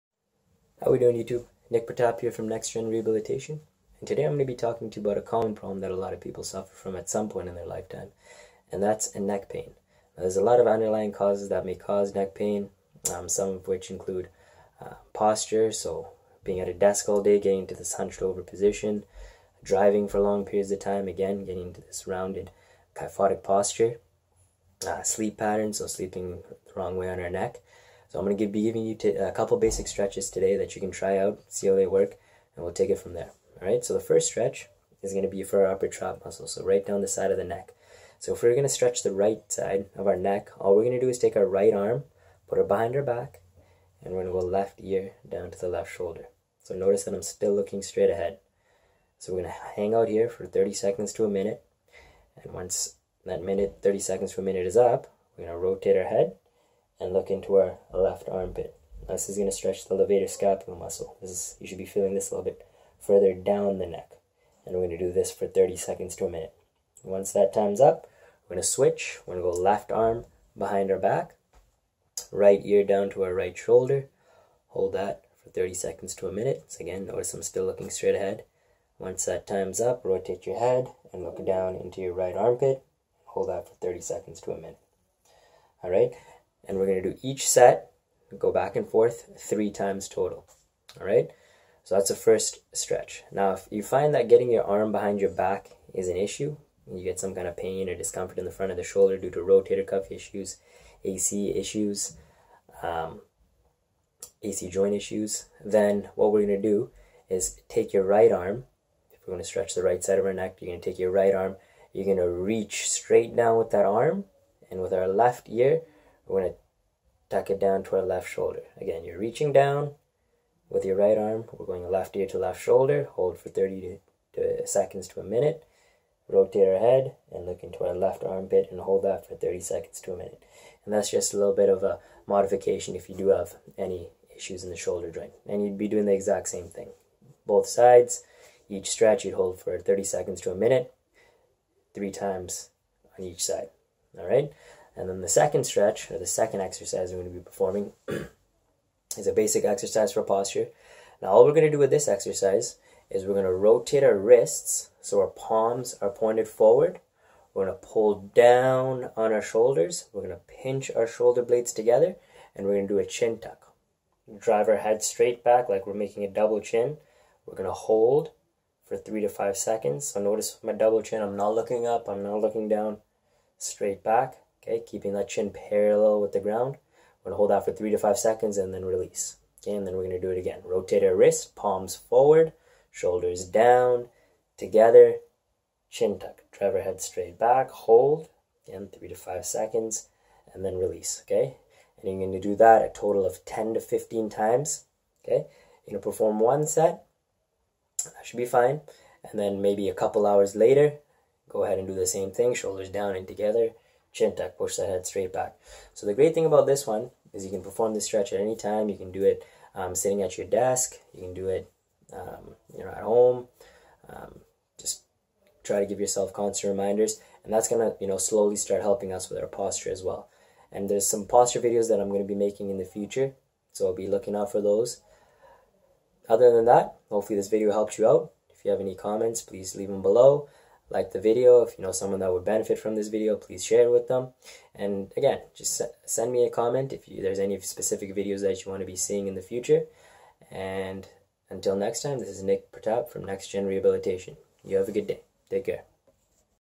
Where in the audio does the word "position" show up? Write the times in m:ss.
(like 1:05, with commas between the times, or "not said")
0:18.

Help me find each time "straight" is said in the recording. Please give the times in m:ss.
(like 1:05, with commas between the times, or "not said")
0:47, 1:17, 1:52, 2:45, 2:53, 3:07, 3:25.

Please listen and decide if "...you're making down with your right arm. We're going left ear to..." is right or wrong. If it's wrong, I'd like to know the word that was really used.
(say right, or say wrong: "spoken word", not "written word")
wrong: "reaching", not "making".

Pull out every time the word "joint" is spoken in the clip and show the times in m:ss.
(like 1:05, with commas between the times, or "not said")
1:44, 2:15.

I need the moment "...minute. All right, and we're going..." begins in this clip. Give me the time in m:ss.
1:24.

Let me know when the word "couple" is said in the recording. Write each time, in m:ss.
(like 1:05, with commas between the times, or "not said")
0:29, 3:19.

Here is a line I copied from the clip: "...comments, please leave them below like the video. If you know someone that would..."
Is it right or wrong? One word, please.
right.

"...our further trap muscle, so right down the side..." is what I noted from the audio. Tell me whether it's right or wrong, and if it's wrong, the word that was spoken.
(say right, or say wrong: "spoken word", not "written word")
wrong: "upper", not "further".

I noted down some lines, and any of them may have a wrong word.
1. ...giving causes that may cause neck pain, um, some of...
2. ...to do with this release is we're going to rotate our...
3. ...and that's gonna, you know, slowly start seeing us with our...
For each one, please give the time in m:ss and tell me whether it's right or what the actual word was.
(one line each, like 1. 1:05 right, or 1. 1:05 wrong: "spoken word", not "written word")
1. 0:10 wrong: "underlying", not "giving"
2. 2:31 wrong: "exercise", not "release"
3. 3:37 wrong: "helping", not "seeing".